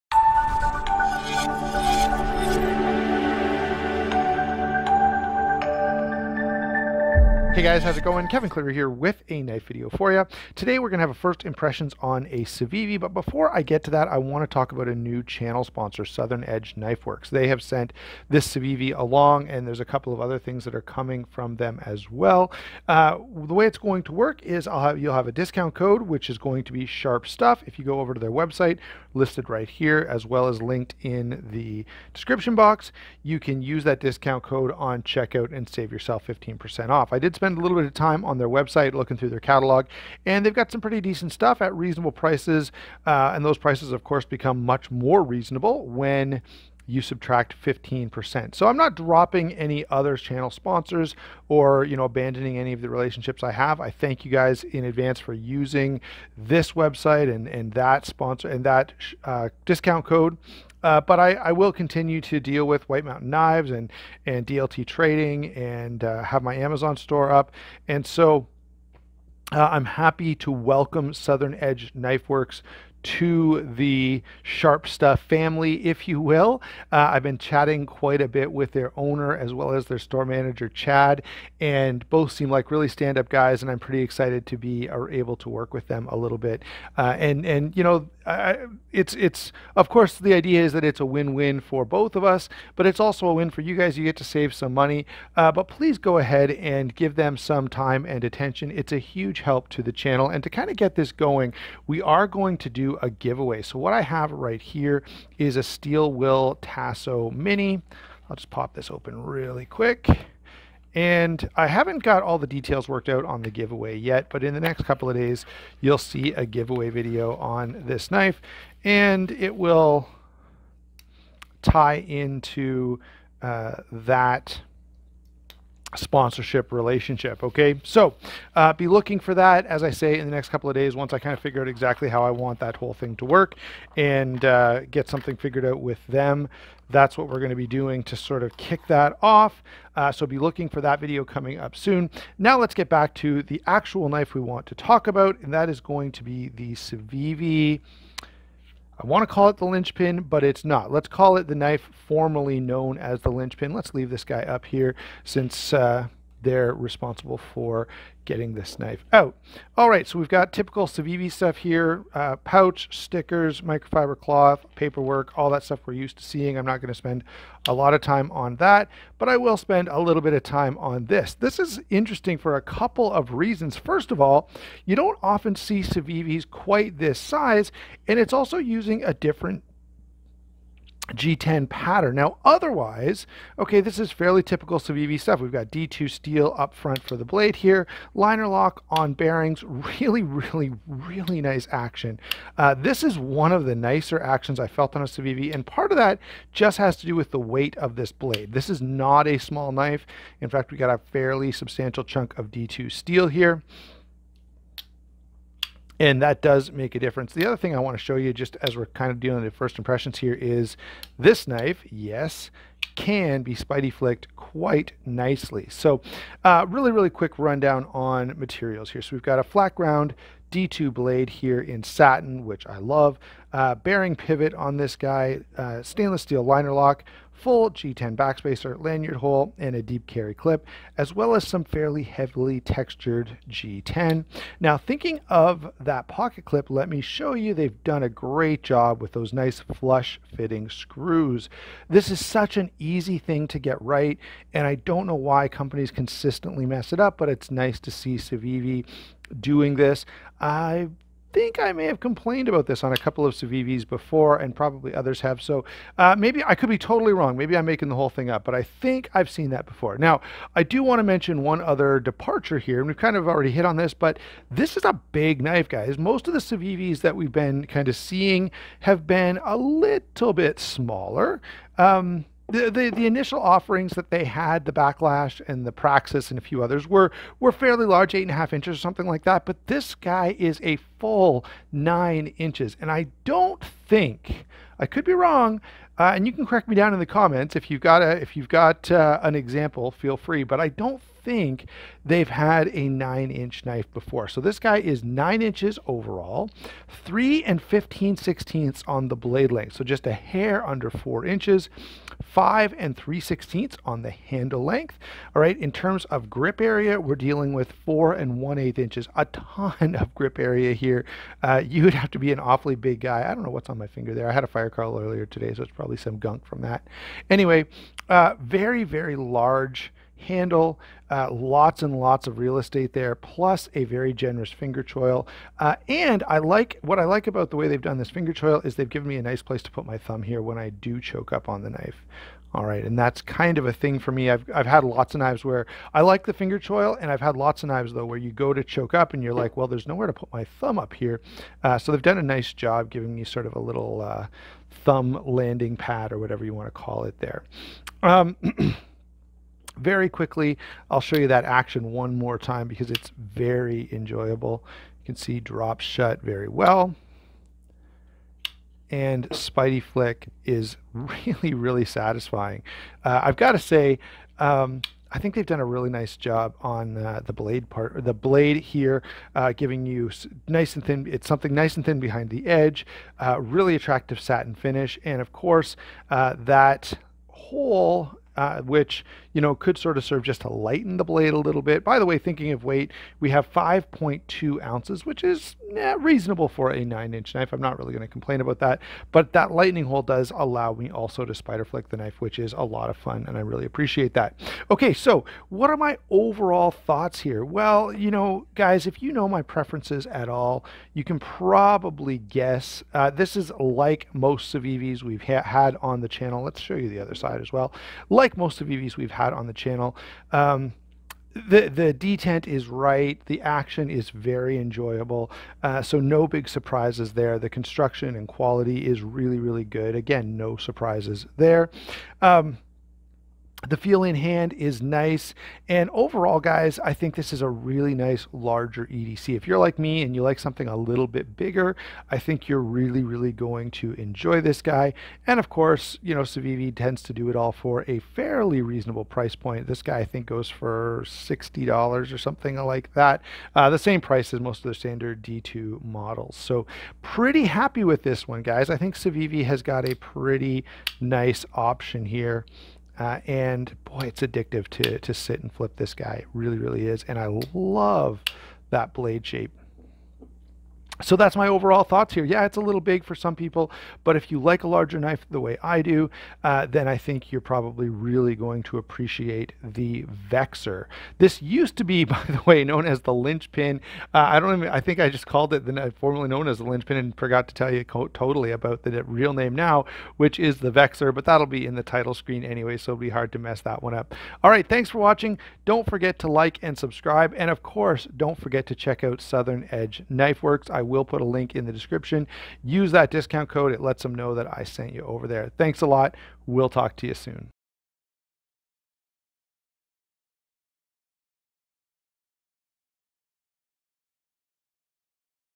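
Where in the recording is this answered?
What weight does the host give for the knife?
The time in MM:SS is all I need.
06:23.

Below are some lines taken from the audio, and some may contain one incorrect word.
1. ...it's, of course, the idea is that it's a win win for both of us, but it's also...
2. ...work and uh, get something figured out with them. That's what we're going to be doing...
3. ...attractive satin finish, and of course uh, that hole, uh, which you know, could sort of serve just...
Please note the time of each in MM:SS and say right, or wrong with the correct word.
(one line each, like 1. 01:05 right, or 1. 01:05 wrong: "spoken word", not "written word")
1. 01:29 right
2. 02:13 right
3. 06:13 right.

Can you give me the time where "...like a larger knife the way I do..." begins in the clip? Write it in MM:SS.
07:44.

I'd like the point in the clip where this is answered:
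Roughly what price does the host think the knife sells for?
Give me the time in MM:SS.
07:21.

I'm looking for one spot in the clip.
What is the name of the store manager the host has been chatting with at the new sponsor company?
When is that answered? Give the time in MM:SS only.
01:20.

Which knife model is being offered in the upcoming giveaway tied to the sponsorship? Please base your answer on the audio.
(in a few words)
Steel Will Tasso Mini.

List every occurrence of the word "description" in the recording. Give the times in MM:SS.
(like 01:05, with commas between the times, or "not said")
00:32, 08:11.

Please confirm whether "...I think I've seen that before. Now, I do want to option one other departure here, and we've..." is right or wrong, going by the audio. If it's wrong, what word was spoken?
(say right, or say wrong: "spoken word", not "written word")
wrong: "mention", not "option".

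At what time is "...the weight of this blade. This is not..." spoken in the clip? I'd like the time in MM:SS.
03:17.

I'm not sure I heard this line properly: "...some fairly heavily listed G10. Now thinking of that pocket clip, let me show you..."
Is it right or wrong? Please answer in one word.
wrong.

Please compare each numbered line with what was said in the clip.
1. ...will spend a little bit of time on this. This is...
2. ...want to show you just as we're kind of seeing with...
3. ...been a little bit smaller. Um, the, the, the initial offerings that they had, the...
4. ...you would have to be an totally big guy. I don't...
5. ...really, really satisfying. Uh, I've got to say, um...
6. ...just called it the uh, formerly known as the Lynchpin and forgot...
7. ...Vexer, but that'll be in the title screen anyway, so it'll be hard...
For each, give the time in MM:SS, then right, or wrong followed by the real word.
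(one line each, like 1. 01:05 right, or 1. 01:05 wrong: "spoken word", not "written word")
1. 02:49 right
2. 03:27 wrong: "dealing", not "seeing"
3. 04:29 right
4. 05:11 wrong: "awfully", not "totally"
5. 06:00 right
6. 07:55 right
7. 08:00 right.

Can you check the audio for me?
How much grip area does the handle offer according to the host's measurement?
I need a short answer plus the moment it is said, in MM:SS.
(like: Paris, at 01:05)
4 1/8 inches, at 05:07.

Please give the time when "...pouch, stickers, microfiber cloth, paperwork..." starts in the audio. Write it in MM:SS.
02:42.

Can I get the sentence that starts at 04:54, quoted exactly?
So this guy is nine inches overall, three and 15 sixteenths on the blade length.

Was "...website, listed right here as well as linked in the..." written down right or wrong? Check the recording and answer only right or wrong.
right.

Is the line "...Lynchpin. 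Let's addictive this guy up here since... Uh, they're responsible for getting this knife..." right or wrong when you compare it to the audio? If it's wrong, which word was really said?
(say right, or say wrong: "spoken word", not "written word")
wrong: "leave", not "addictive".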